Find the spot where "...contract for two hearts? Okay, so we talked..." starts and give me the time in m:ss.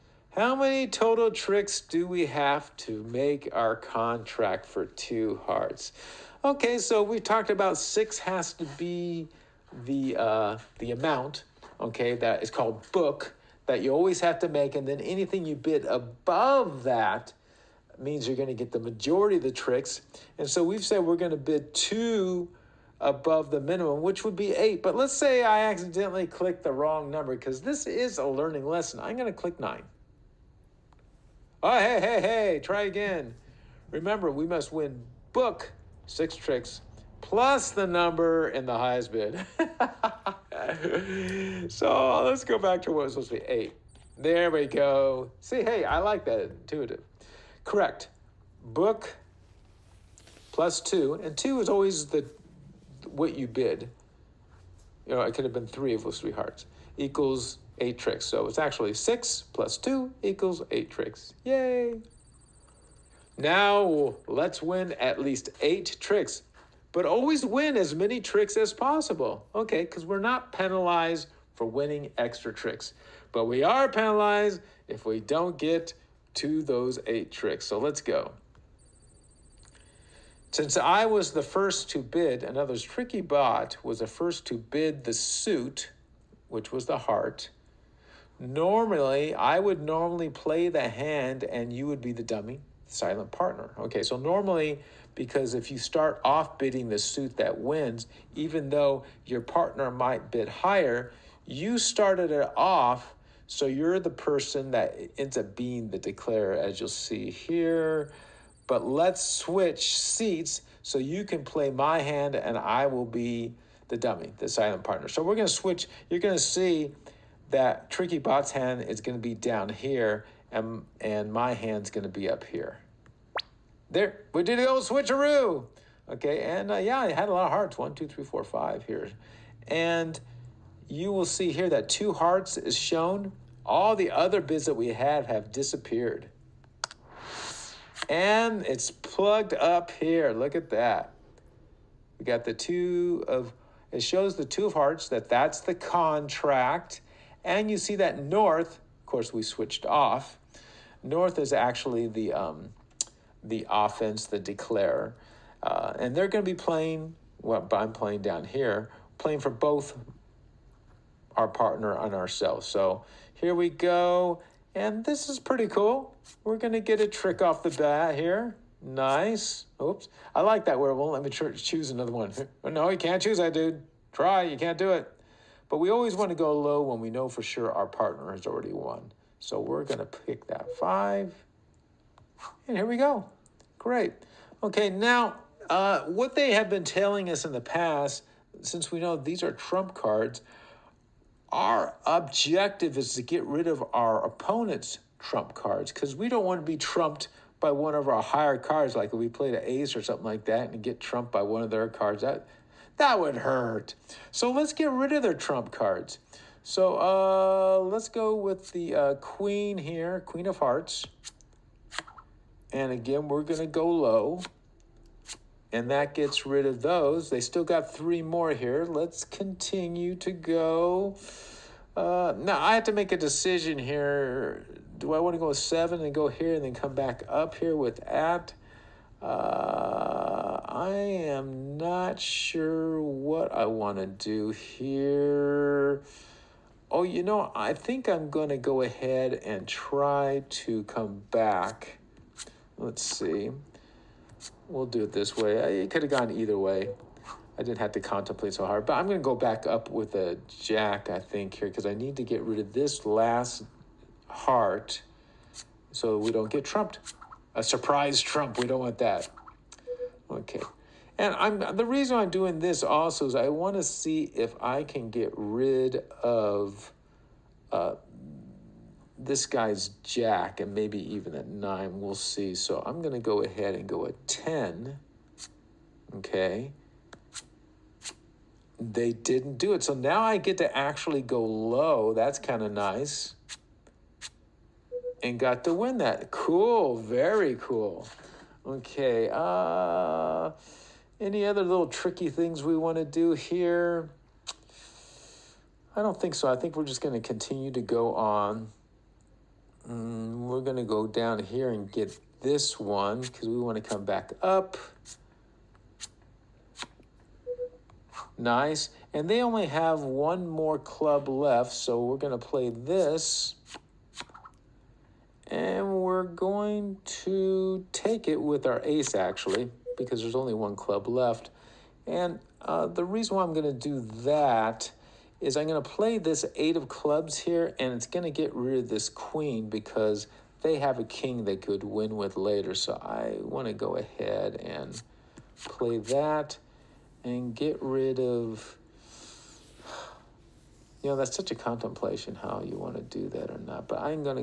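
0:03.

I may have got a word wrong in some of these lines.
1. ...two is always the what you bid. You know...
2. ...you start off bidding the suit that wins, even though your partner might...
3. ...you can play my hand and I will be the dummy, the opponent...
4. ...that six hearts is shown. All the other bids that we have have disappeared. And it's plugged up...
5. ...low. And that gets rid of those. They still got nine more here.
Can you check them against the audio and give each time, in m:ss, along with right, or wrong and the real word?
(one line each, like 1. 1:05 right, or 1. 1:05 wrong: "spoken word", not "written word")
1. 0:51 right
2. 1:35 right
3. 1:50 wrong: "silent", not "opponent"
4. 2:11 wrong: "two", not "six"
5. 3:33 wrong: "three", not "nine".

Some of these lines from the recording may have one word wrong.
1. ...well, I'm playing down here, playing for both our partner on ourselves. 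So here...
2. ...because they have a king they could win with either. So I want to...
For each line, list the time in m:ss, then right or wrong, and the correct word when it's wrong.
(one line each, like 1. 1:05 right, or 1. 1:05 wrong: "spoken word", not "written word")
1. 2:37 right
2. 5:29 wrong: "later", not "either".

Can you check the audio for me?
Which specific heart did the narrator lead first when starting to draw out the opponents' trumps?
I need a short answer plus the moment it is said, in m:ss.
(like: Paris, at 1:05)
Queen of hearts, at 3:30.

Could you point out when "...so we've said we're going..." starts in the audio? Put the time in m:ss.
0:20.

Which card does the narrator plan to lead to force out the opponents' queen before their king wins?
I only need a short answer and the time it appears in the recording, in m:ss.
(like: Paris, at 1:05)
Eight of clubs, at 5:26.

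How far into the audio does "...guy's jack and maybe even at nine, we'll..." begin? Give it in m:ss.
4:29.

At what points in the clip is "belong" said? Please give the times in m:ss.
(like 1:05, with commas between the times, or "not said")
not said.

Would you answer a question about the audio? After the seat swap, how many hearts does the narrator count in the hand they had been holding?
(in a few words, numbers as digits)
5.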